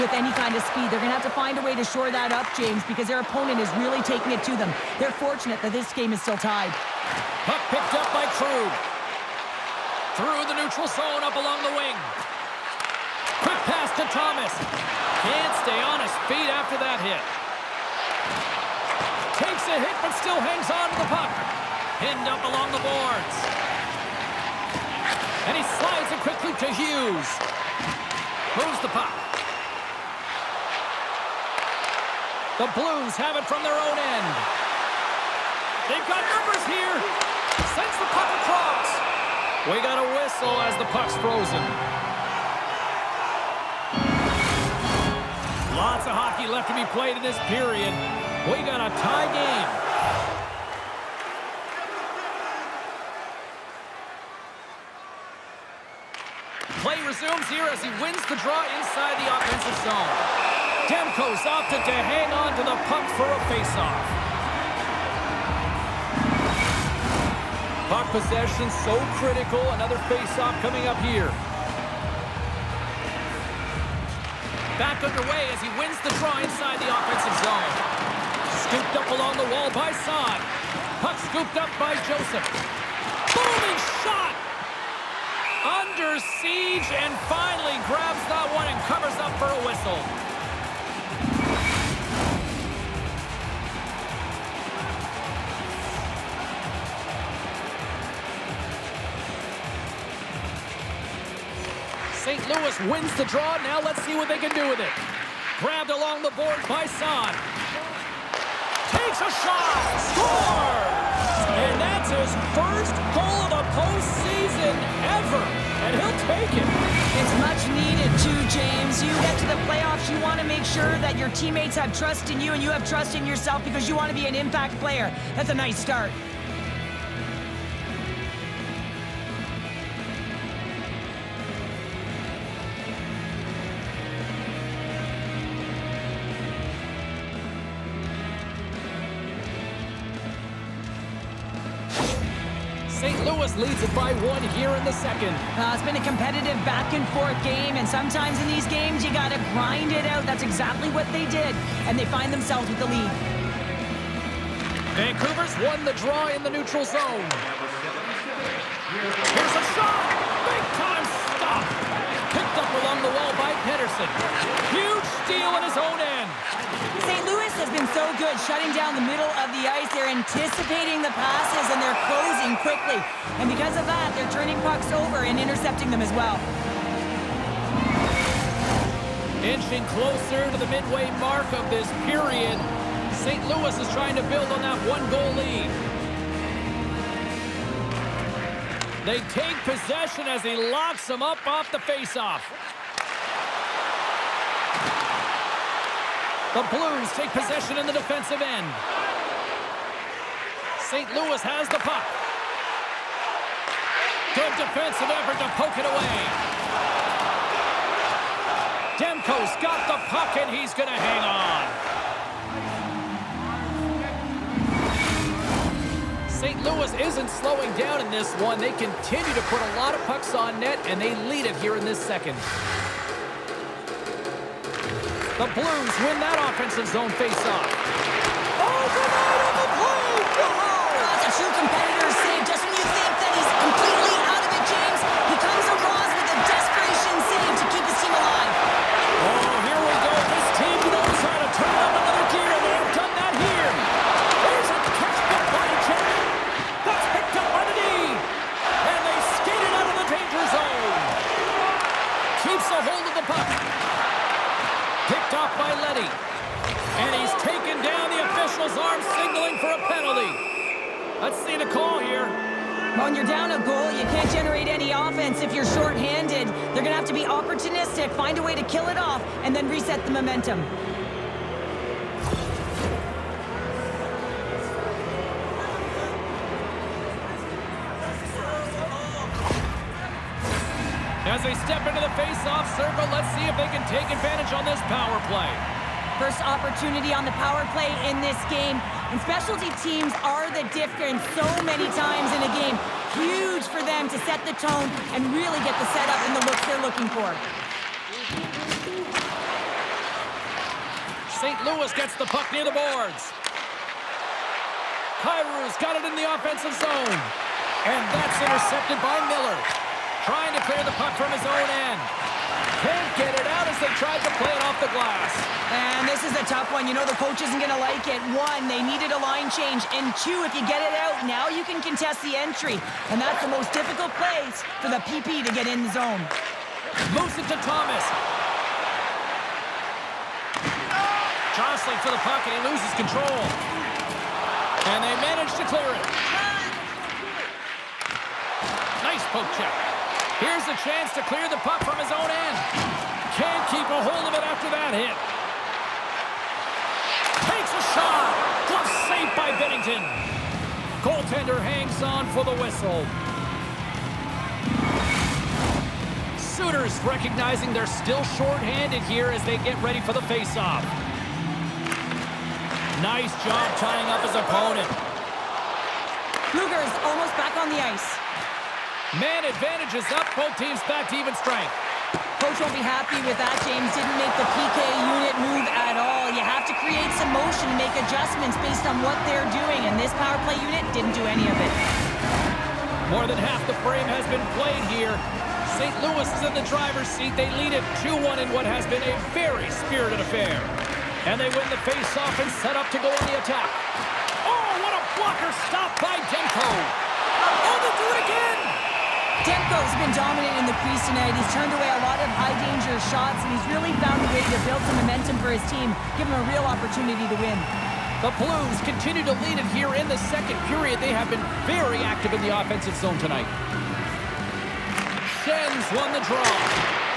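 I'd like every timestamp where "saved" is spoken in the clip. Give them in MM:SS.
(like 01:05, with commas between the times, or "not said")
03:52, 05:49.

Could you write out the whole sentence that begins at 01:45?
Grabbed along the board by Son.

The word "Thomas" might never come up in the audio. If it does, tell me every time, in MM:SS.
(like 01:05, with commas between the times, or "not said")
00:14, 05:27.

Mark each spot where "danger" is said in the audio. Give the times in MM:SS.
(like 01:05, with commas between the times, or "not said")
06:42.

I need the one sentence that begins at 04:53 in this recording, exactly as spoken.
Huge for them to set the tone and really get the setup and the looks they're looking for.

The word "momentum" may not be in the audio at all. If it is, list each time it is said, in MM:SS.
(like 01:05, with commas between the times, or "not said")
04:30, 06:45.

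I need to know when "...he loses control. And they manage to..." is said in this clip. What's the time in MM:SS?
05:32.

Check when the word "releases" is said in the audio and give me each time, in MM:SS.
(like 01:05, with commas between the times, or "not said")
not said.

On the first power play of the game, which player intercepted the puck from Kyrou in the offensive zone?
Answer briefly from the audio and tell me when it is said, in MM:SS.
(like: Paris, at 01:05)
Miller, at 05:09.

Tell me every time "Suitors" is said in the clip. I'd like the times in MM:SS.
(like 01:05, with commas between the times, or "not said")
05:56.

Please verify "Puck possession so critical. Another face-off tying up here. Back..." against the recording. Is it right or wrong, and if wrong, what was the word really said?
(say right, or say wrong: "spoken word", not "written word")
wrong: "coming", not "tying".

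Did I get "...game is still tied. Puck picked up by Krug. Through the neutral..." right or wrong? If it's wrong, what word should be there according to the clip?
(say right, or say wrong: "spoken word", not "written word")
right.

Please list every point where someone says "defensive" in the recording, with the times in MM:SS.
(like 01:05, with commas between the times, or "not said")
03:17, 03:24.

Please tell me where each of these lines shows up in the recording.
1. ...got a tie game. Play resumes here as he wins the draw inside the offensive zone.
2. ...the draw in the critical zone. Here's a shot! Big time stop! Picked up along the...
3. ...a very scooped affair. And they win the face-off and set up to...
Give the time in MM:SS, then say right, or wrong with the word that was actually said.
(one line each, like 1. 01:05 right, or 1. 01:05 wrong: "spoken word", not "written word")
1. 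00:48 right
2. 02:35 wrong: "neutral", not "critical"
3. 06:29 wrong: "spirited", not "scooped".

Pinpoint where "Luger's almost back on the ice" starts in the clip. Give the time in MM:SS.
06:06.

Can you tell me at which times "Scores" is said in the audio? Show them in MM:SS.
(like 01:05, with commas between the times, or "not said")
01:50.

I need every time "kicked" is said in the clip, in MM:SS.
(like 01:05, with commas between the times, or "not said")
not said.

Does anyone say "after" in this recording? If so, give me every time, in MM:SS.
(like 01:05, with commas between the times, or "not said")
00:16, 05:44.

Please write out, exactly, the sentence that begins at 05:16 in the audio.
You know the coach isn't going to like it.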